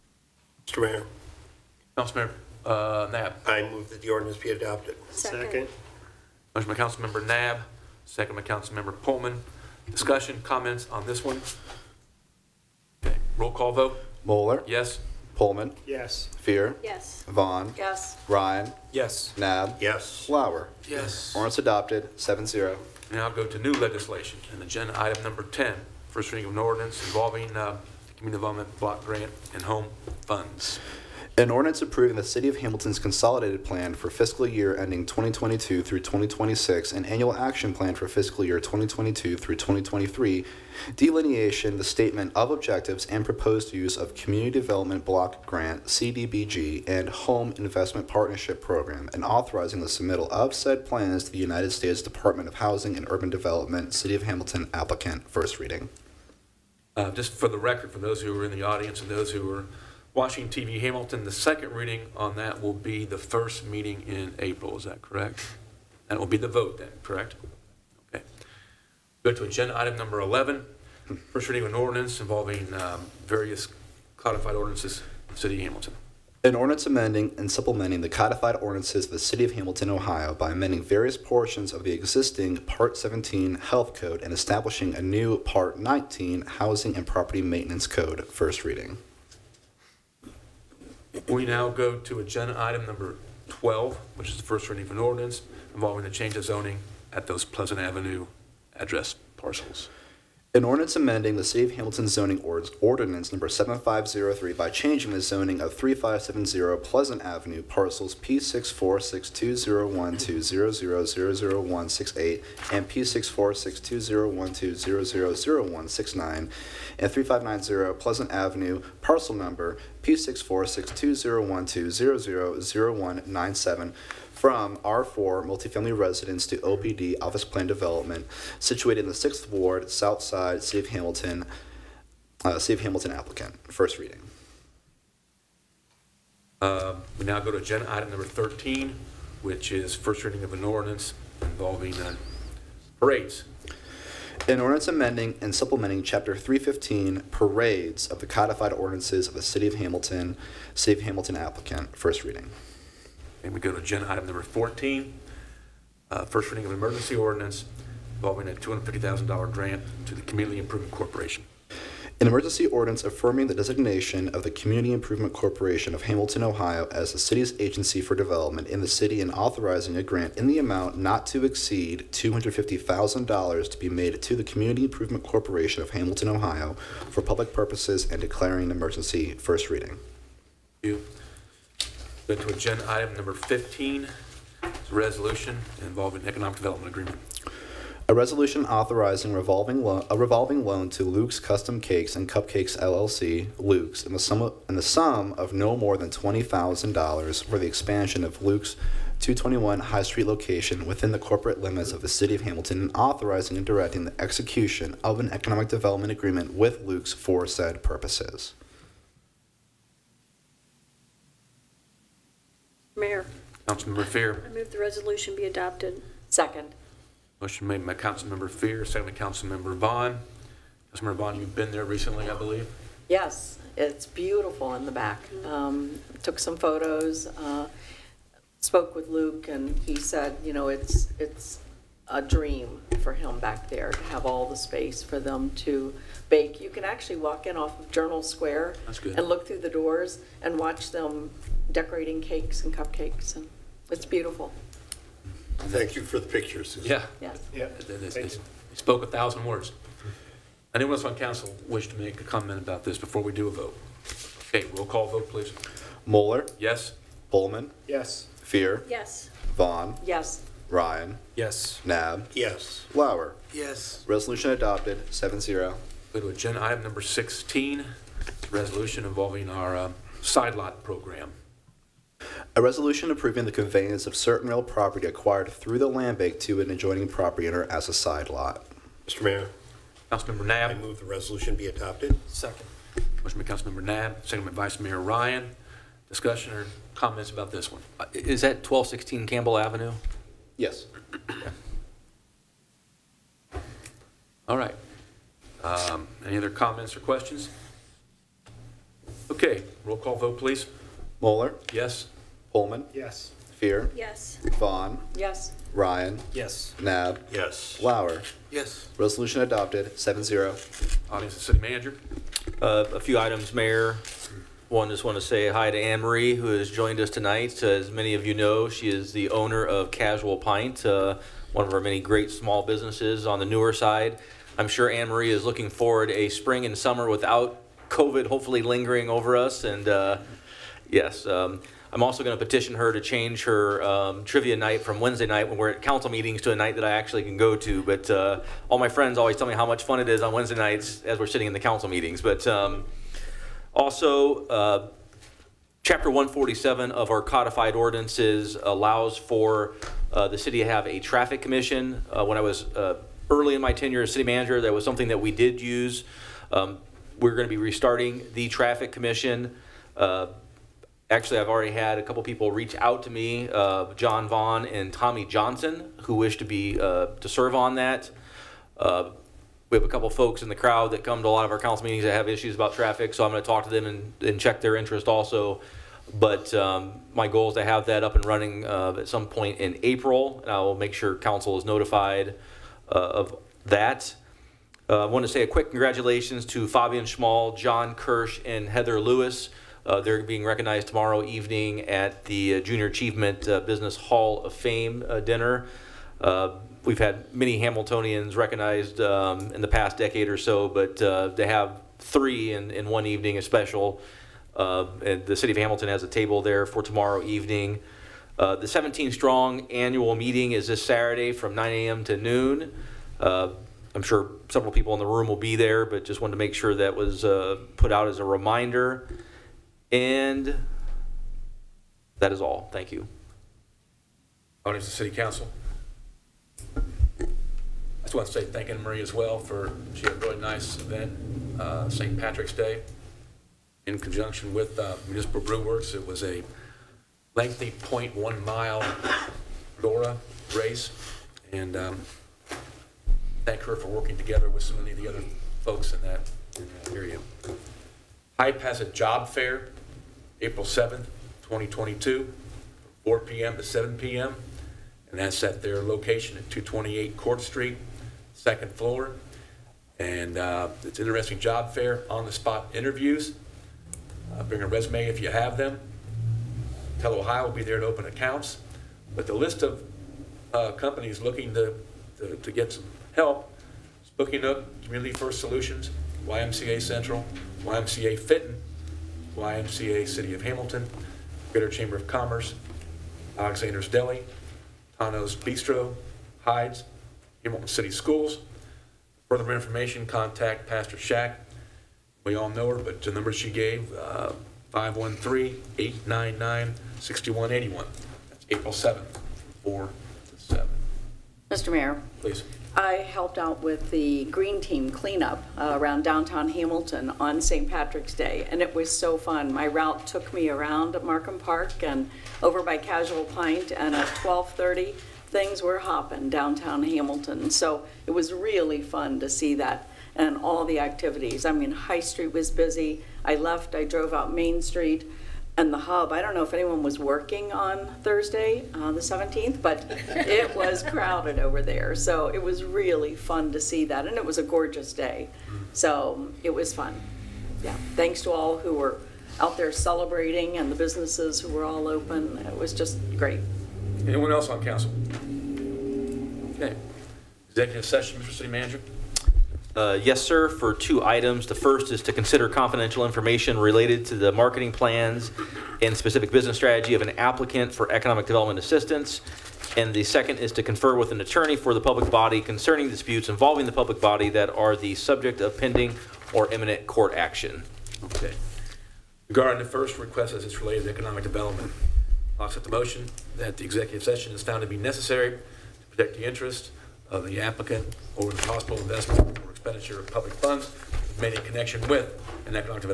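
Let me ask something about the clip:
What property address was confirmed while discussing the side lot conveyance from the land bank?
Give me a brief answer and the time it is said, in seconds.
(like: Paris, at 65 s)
1216 Campbell Avenue, at 288 s.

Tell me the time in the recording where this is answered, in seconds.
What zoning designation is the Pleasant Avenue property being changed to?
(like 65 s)
126 s.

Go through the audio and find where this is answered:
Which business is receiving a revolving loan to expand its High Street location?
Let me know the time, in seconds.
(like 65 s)
191 s.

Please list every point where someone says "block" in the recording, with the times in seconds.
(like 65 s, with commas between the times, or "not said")
28 s, 45 s.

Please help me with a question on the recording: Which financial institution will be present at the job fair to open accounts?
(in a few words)
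Telhio.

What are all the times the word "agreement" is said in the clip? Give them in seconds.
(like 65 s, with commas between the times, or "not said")
186 s, 206 s.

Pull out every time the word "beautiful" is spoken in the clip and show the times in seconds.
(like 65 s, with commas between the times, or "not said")
224 s, 244 s.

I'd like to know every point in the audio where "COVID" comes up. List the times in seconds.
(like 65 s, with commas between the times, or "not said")
327 s.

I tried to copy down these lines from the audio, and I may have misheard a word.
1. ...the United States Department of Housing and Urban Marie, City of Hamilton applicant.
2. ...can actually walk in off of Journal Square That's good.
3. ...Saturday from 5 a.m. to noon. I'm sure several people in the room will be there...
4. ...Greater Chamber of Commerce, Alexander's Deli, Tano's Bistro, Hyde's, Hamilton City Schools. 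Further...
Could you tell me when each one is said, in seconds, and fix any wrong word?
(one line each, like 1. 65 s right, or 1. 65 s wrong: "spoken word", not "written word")
1. 51 s wrong: "Development", not "Marie"
2. 236 s right
3. 410 s wrong: "9", not "5"
4. 481 s right.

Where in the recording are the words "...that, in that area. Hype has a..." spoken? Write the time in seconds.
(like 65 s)
446 s.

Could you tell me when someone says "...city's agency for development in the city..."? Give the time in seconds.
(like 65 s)
167 s.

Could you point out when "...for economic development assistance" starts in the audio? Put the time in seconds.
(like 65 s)
557 s.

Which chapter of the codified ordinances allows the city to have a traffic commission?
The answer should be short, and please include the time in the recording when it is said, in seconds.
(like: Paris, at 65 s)
Chapter 147, at 345 s.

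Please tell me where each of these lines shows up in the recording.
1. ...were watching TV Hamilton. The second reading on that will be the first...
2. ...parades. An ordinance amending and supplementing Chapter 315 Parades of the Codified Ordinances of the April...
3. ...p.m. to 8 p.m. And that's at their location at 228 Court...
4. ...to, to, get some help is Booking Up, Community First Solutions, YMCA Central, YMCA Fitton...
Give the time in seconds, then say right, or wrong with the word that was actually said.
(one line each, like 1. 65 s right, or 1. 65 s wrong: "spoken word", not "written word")
1. 59 s right
2. 143 s wrong: "City", not "April"
3. 453 s wrong: "7", not "8"
4. 472 s right.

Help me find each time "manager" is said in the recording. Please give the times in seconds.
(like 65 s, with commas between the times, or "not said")
311 s, 354 s, 548 s.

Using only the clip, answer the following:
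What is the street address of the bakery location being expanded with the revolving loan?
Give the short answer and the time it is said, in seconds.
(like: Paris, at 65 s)
221 High Street, at 199 s.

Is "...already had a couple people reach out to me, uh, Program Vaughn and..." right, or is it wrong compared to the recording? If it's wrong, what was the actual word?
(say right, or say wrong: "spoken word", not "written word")
wrong: "John", not "Program".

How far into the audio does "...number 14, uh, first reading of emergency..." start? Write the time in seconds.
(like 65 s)
154 s.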